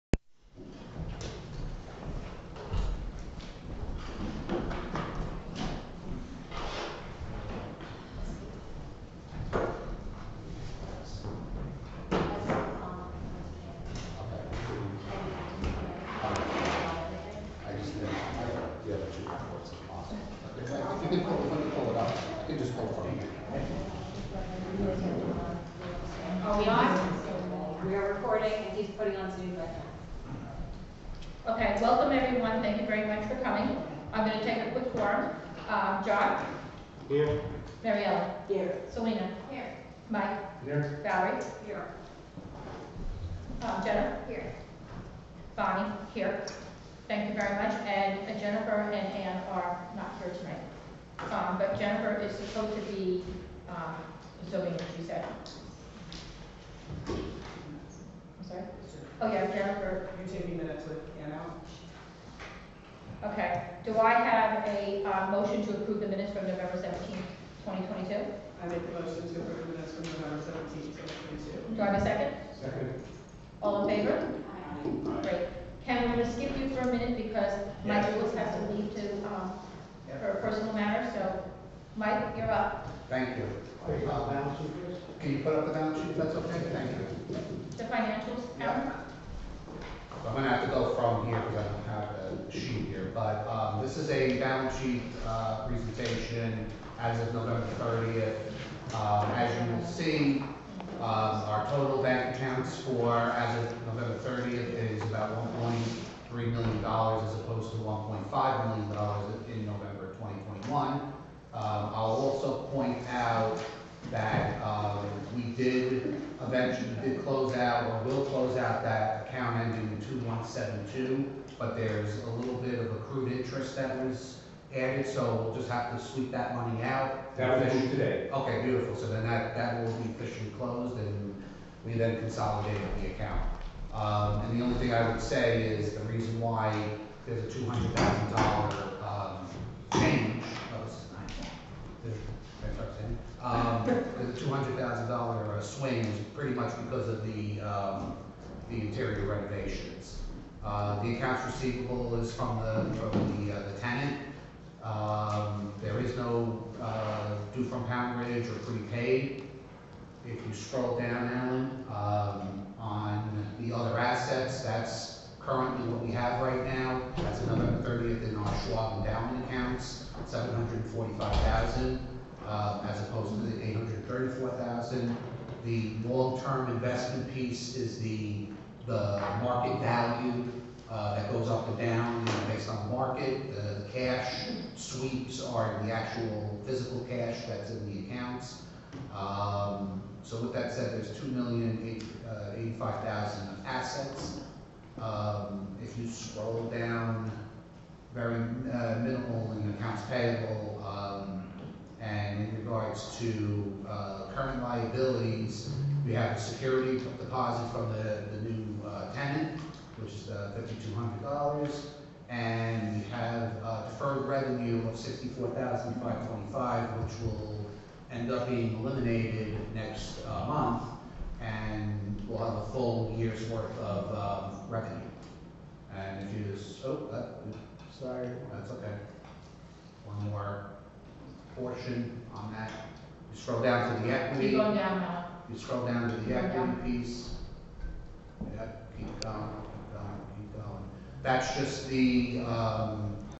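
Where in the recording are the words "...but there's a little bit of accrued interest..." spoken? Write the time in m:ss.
2:01.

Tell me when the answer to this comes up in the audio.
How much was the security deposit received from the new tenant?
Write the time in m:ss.
3:30.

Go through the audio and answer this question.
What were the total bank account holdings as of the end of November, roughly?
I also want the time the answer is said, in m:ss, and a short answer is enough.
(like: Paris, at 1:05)
$1.3 million, at 1:45.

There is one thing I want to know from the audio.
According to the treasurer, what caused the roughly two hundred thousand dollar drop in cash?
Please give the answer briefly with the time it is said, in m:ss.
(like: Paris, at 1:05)
interior renovations, at 2:28.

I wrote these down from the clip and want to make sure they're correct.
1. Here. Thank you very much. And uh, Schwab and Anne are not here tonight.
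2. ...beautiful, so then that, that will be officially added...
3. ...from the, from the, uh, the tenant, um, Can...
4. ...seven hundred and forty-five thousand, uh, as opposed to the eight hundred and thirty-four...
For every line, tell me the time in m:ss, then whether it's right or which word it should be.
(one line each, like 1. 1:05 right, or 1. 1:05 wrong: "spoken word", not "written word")
1. 0:46 wrong: "Jennifer", not "Schwab"
2. 2:08 wrong: "closed", not "added"
3. 2:32 wrong: "There", not "Can"
4. 2:50 right.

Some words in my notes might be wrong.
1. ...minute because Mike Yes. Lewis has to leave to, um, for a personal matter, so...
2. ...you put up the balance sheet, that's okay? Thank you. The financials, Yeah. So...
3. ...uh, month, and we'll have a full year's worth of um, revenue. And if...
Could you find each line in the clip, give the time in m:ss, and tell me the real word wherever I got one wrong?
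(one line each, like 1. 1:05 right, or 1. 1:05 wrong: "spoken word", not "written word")
1. 1:16 right
2. 1:25 right
3. 3:40 right.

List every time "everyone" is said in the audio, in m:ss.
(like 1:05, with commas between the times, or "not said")
0:32.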